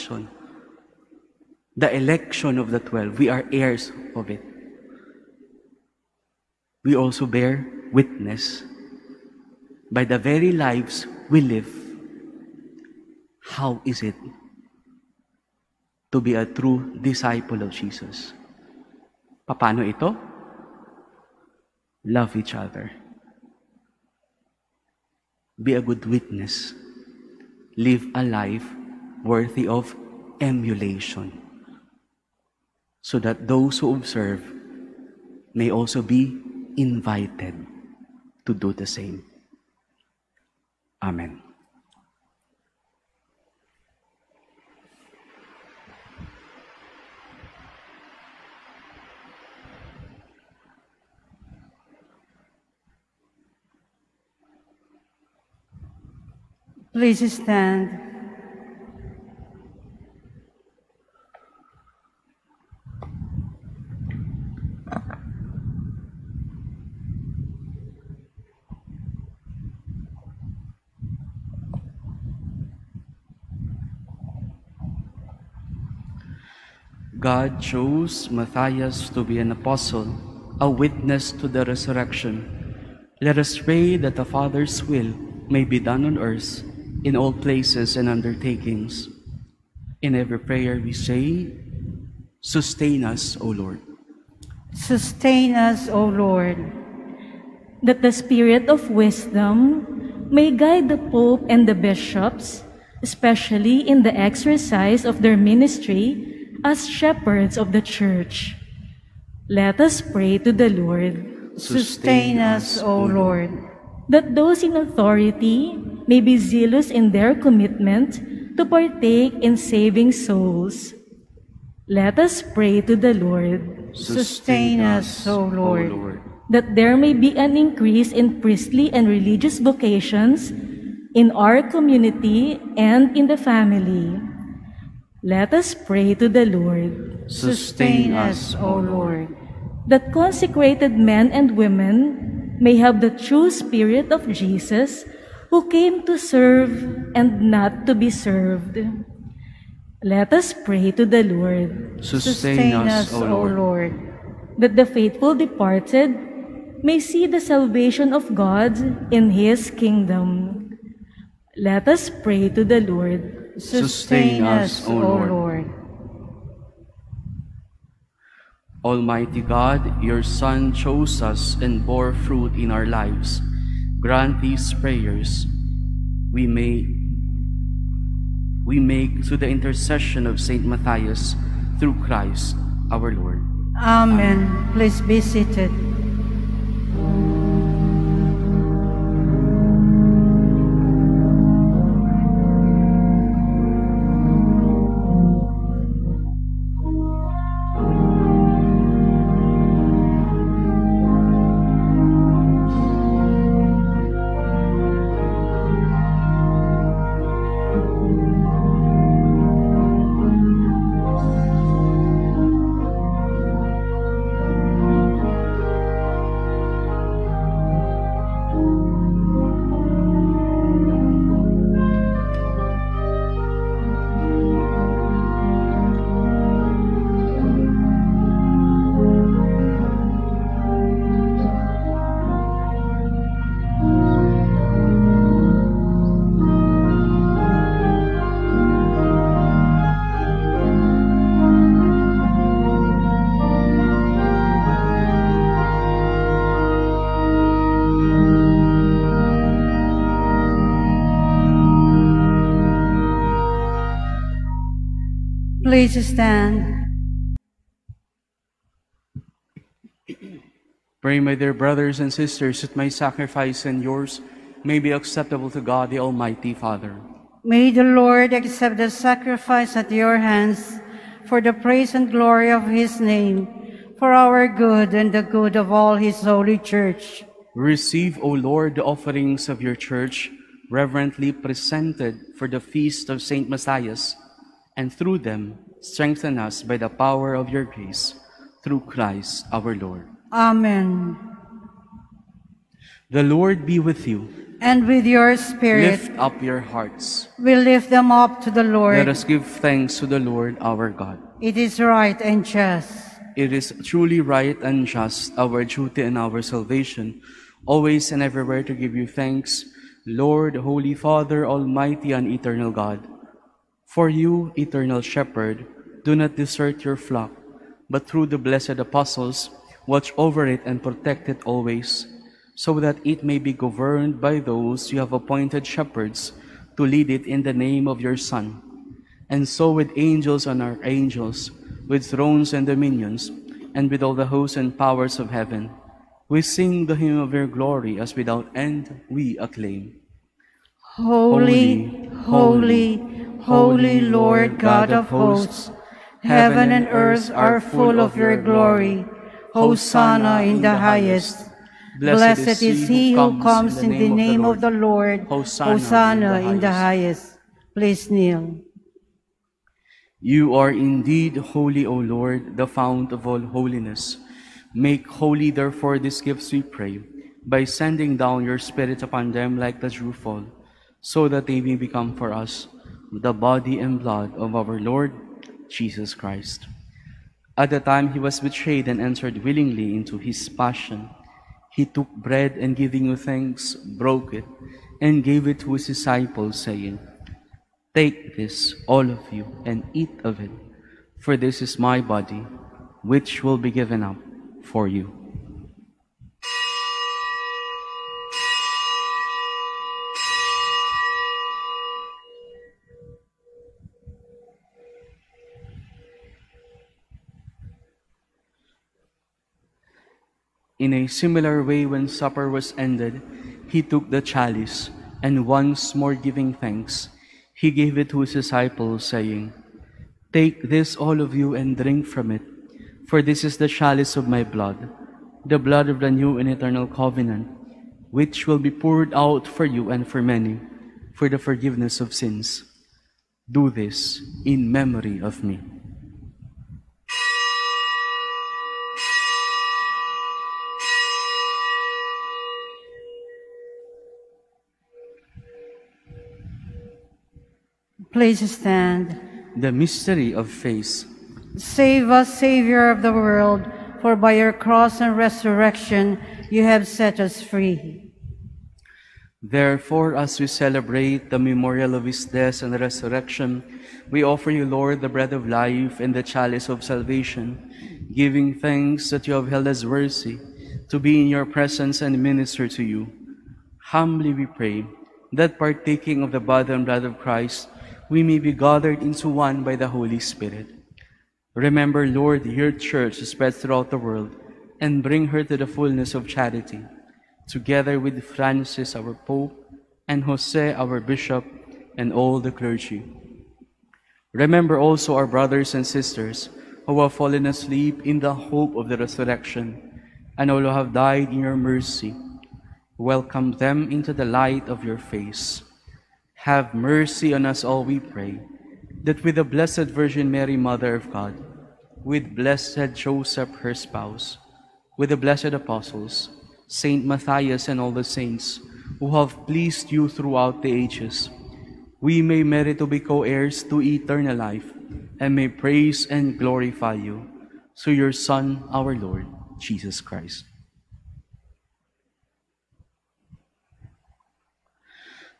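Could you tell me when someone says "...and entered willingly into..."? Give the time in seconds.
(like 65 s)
378 s.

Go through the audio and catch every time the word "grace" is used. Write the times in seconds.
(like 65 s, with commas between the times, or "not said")
287 s.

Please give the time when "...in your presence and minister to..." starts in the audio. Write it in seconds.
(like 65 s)
471 s.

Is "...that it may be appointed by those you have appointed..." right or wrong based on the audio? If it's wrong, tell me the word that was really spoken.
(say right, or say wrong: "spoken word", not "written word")
wrong: "governed", not "appointed".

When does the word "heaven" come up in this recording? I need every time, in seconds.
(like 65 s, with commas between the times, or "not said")
335 s, 346 s.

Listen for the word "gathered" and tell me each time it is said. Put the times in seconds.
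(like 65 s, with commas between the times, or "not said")
478 s.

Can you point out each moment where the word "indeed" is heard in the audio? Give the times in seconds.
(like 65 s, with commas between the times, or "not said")
360 s.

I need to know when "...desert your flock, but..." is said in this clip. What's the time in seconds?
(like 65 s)
316 s.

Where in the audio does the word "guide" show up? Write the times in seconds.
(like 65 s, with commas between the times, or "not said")
100 s.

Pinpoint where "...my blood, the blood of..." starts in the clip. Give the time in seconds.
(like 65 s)
424 s.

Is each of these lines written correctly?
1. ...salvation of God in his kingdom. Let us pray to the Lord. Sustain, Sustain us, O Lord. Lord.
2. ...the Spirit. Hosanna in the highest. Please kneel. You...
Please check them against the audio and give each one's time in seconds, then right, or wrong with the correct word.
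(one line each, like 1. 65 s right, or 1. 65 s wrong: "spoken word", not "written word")
1. 157 s right
2. 354 s wrong: "Lord", not "Spirit".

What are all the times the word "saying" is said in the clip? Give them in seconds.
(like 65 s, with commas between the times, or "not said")
386 s, 419 s.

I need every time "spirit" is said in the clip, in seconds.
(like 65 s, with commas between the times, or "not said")
98 s, 143 s, 295 s, 368 s, 480 s.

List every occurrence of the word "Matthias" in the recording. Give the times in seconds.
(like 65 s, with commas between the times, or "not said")
78 s, 180 s, 283 s, 517 s.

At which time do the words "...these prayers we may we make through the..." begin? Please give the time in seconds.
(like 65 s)
174 s.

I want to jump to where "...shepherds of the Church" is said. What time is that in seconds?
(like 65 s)
106 s.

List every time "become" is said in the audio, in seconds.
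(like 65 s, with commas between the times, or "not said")
371 s.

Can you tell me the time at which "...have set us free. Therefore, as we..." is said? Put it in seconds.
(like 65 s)
456 s.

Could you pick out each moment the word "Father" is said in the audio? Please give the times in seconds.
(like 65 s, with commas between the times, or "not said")
84 s, 266 s, 310 s.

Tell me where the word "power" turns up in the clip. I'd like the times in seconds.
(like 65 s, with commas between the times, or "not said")
286 s, 334 s.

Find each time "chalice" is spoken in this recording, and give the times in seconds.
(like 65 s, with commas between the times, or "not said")
414 s, 423 s, 466 s.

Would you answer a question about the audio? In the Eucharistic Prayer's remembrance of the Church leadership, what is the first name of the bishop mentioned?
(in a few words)
Jose.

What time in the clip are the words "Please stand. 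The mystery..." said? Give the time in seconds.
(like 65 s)
448 s.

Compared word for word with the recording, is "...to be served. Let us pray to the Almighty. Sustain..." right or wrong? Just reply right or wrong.
wrong.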